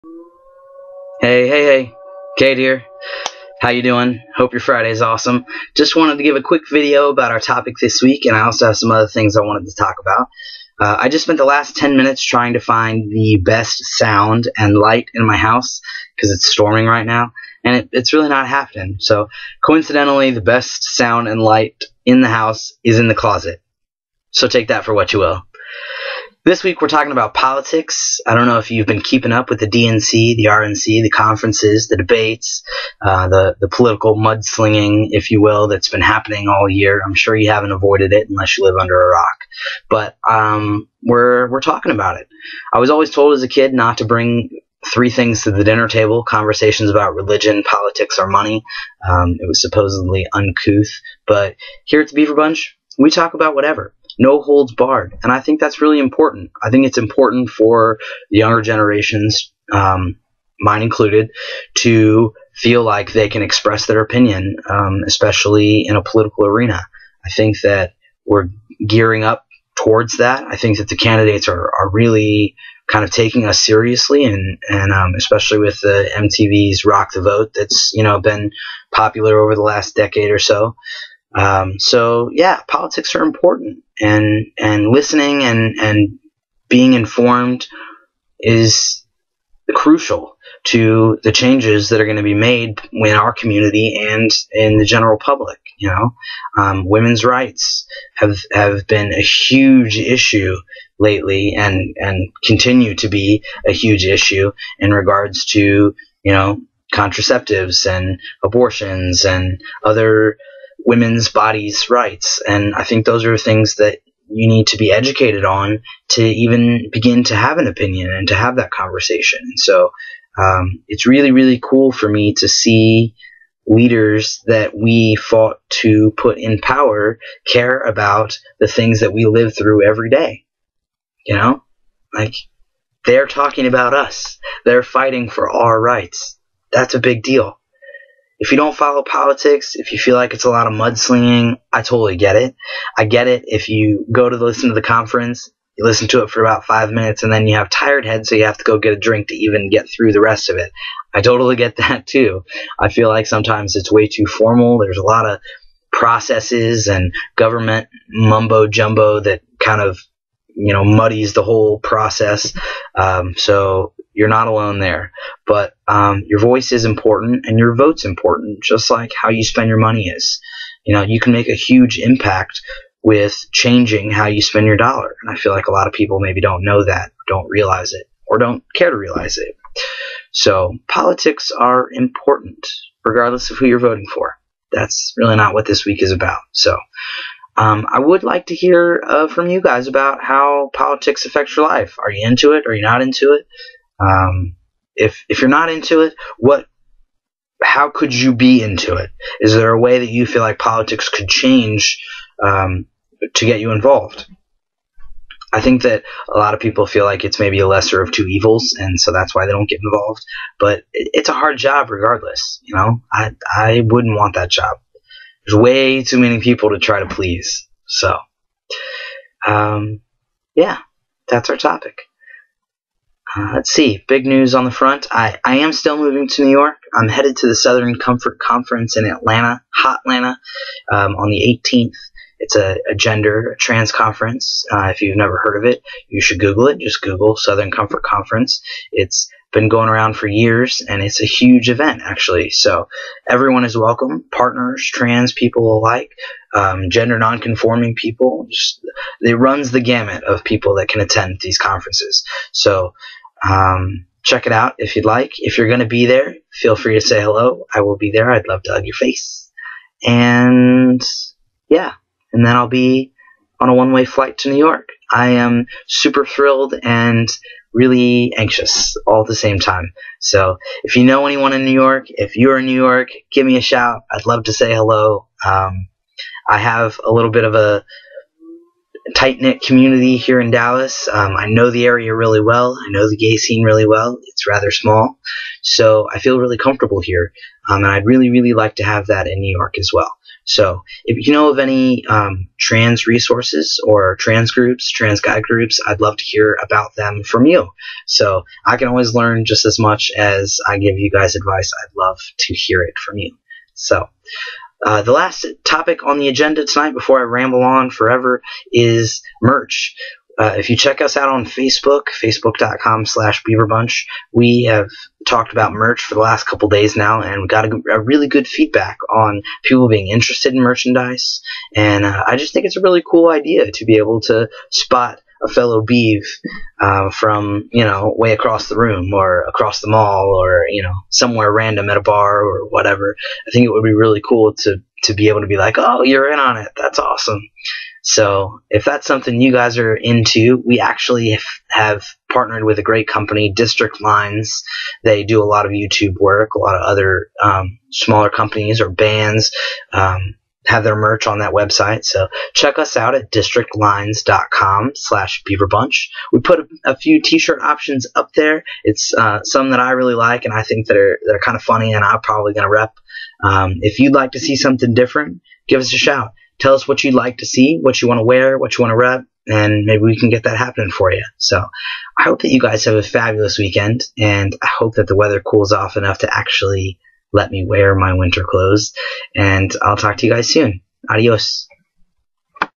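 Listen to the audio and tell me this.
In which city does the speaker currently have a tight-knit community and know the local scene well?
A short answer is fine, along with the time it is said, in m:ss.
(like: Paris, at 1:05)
Dallas, at 4:40.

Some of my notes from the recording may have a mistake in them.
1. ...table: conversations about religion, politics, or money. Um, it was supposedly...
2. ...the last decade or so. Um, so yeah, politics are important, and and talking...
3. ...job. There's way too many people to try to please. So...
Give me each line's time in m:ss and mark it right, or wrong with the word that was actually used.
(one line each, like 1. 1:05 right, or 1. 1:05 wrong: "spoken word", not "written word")
1. 0:45 right
2. 1:19 wrong: "listening", not "talking"
3. 3:34 right.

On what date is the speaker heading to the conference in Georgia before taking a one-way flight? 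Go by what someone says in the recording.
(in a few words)
the 18th.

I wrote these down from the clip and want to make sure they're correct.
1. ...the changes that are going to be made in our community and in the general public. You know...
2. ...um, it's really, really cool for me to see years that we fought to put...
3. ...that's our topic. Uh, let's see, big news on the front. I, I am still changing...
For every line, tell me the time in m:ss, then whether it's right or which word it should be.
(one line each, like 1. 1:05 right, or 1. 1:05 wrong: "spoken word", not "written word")
1. 1:31 right
2. 2:00 wrong: "leaders", not "years"
3. 3:41 wrong: "moving", not "changing".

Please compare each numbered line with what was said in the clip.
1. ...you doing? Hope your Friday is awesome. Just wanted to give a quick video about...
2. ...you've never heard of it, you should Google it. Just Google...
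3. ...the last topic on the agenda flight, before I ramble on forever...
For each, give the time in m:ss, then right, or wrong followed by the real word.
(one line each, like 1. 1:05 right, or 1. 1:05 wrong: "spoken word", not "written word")
1. 0:03 right
2. 3:55 right
3. 5:05 wrong: "tonight", not "flight".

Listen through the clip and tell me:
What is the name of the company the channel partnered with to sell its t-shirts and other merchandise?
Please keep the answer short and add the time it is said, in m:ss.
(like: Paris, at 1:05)
District Lines, at 5:43.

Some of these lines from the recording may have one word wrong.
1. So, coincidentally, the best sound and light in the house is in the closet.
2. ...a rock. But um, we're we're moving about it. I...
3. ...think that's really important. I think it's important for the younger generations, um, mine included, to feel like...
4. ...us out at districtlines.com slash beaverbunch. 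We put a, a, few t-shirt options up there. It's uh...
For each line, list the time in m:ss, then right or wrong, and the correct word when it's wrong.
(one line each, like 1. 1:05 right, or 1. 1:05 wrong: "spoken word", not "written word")
1. 0:18 right
2. 0:38 wrong: "talking", not "moving"
3. 0:55 right
4. 5:52 right.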